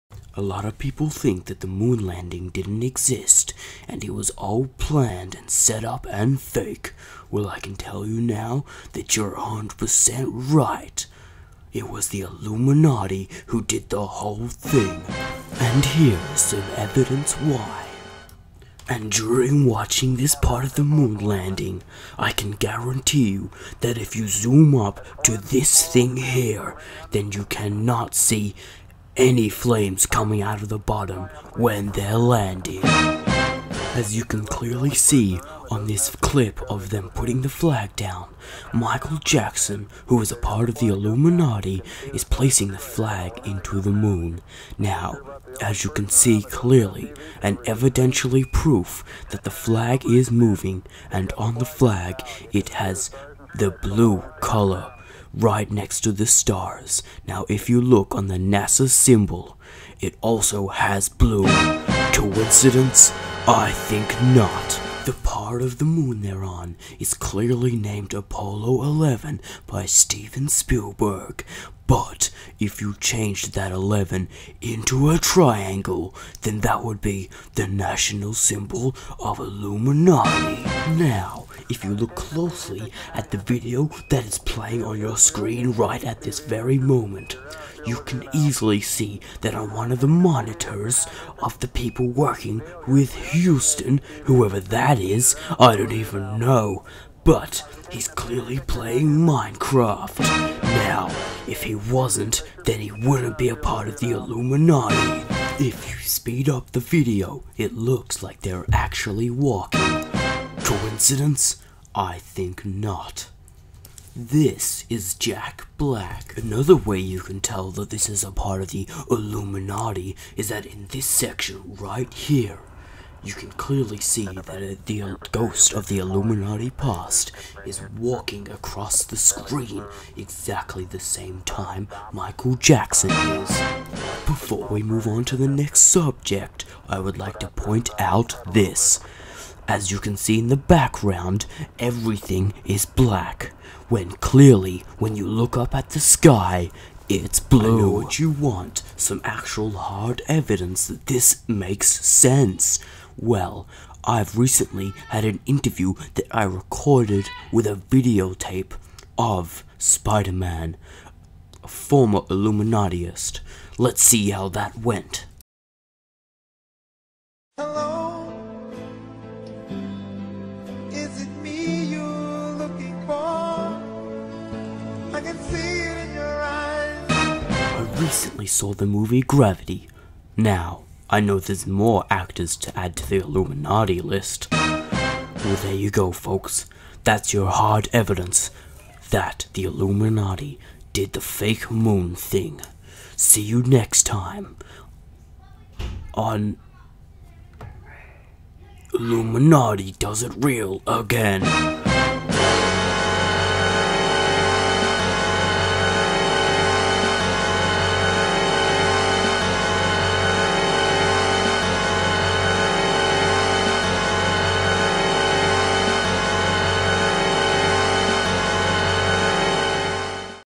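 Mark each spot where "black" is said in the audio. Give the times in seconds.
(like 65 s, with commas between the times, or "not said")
115 s, 142 s.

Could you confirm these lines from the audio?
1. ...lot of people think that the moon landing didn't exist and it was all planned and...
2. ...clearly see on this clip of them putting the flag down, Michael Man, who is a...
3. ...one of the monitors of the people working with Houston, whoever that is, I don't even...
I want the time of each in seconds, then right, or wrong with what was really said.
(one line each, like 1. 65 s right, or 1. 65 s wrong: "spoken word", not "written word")
1. 0 s right
2. 34 s wrong: "Jackson", not "Man"
3. 89 s right.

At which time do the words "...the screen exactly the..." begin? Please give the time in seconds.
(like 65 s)
129 s.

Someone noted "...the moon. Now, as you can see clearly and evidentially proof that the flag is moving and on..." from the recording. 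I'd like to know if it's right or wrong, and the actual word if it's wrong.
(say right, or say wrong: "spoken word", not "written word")
right.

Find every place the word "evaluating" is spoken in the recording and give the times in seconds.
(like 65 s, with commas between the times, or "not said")
not said.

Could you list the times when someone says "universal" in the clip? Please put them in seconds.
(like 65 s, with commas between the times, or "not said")
not said.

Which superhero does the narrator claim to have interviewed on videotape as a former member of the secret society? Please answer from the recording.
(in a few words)
Spider Man.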